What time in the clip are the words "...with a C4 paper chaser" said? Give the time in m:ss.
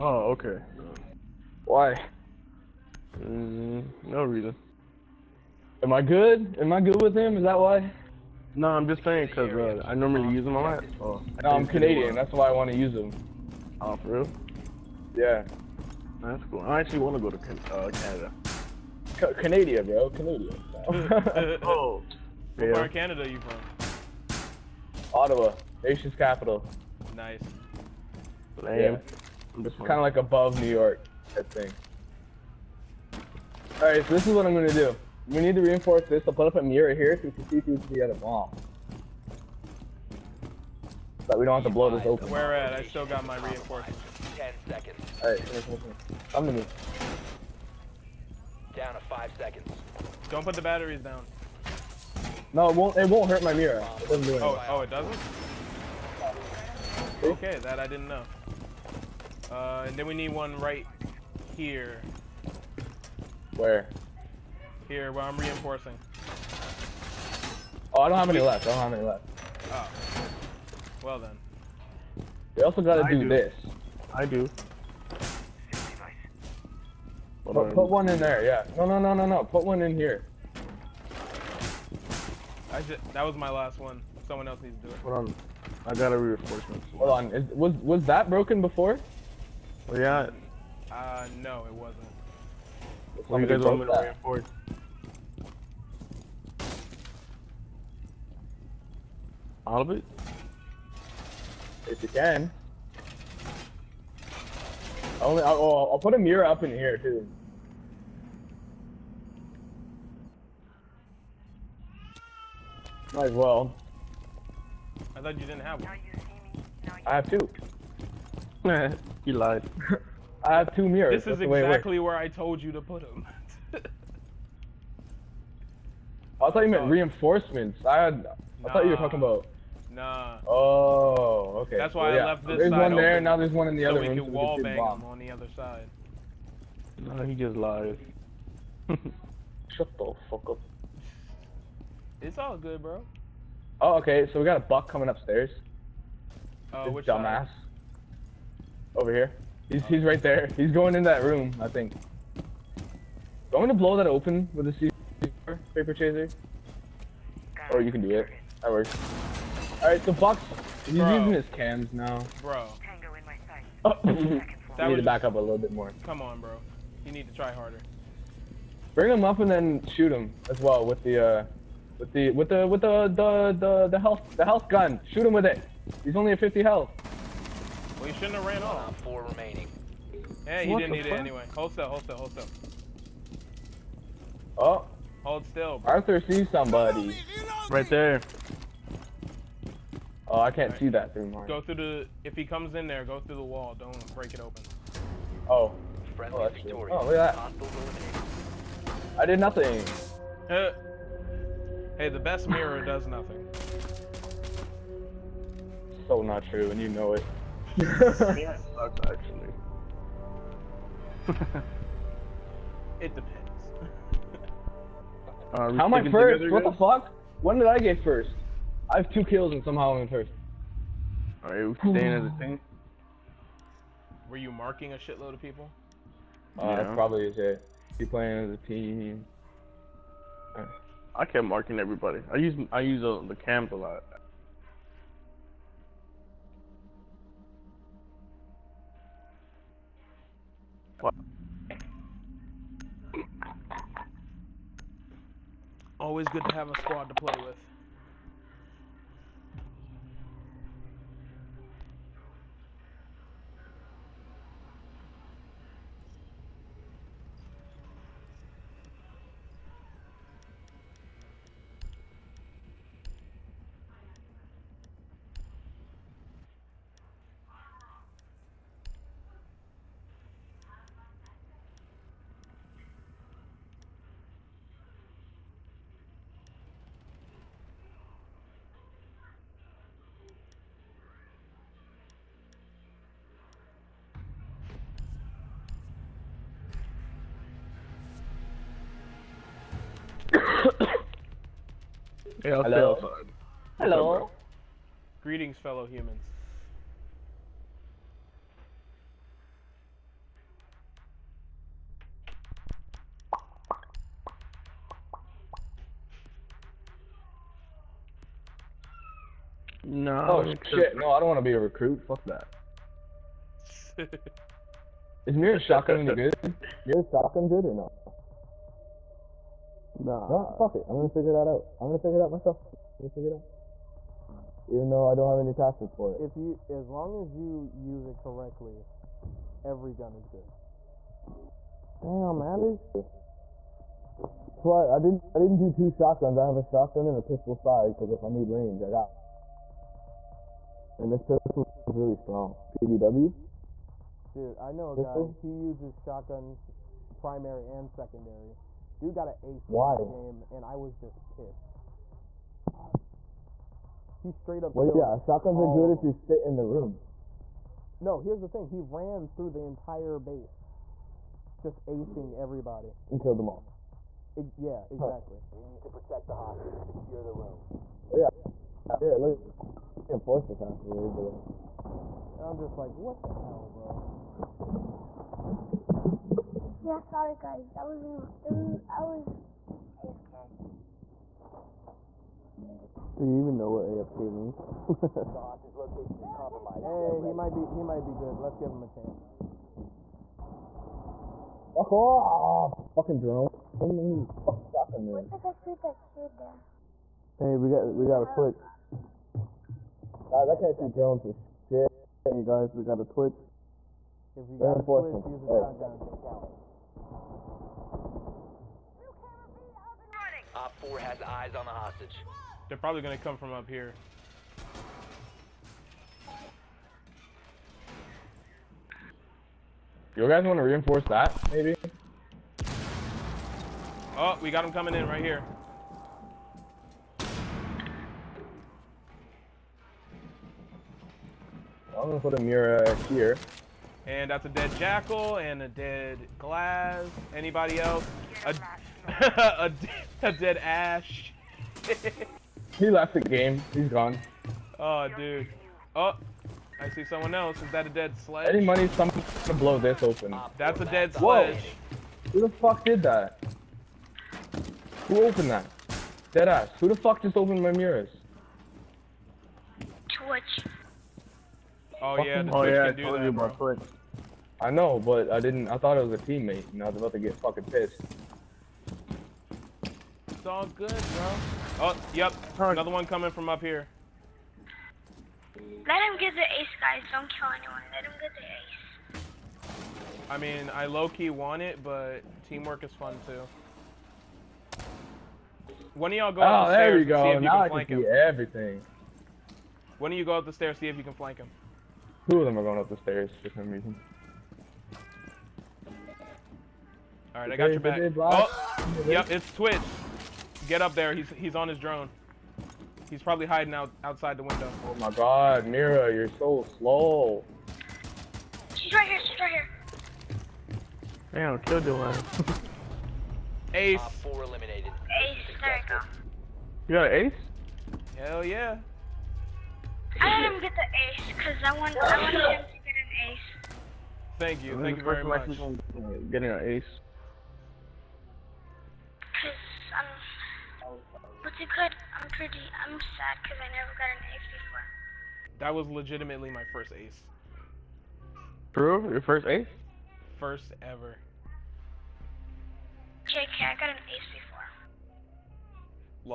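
2:34.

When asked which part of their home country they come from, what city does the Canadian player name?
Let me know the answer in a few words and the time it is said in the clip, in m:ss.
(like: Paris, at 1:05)
Ottawa, at 0:25.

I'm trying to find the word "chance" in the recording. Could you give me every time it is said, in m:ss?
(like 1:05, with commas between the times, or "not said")
6:28.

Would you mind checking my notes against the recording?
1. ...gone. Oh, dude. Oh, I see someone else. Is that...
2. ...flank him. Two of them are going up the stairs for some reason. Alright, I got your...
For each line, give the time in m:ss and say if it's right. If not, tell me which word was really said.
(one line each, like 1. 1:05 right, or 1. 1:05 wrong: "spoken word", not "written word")
1. 7:23 right
2. 8:11 right.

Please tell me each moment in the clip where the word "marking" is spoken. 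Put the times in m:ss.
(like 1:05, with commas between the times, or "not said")
3:44, 3:51.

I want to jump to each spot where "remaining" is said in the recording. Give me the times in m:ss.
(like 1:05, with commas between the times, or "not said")
2:59.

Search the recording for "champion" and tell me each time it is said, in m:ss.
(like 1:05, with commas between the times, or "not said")
not said.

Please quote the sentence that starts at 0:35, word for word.
We need to reinforce this, so put up a mirror here so we can see through to the other wall.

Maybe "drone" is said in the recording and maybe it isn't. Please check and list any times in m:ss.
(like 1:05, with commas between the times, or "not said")
6:33, 6:40, 8:21.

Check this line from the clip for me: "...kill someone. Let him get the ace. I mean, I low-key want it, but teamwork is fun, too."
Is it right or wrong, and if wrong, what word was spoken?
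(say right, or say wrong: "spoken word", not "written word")
wrong: "anyone", not "someone".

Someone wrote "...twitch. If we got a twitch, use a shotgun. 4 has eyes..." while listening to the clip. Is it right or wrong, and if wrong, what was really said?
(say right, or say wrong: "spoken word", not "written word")
right.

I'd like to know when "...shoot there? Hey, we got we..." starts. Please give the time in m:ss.
6:36.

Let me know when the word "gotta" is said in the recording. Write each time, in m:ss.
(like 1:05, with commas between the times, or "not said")
1:12, 6:38.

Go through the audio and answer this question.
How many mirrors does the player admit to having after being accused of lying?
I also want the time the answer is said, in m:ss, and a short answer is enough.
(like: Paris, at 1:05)
2, at 2:00.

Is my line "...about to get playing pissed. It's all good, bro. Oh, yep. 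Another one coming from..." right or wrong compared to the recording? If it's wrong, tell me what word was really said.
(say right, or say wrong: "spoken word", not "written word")
wrong: "fucking", not "playing".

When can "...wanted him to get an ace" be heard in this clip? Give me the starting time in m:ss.
8:42.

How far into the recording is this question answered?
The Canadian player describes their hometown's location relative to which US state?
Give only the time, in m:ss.
0:30.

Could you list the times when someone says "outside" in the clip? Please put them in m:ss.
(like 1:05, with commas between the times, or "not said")
8:24.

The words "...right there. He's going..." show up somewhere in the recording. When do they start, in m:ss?
2:30.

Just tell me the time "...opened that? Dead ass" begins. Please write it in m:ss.
7:35.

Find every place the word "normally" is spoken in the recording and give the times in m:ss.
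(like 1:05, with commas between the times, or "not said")
0:09.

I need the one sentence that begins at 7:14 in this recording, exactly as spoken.
And that's a dead jackal and a dead glass.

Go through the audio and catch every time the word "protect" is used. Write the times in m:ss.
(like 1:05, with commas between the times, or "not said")
6:05.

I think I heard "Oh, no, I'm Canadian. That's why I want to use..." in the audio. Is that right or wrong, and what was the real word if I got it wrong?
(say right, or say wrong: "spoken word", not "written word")
right.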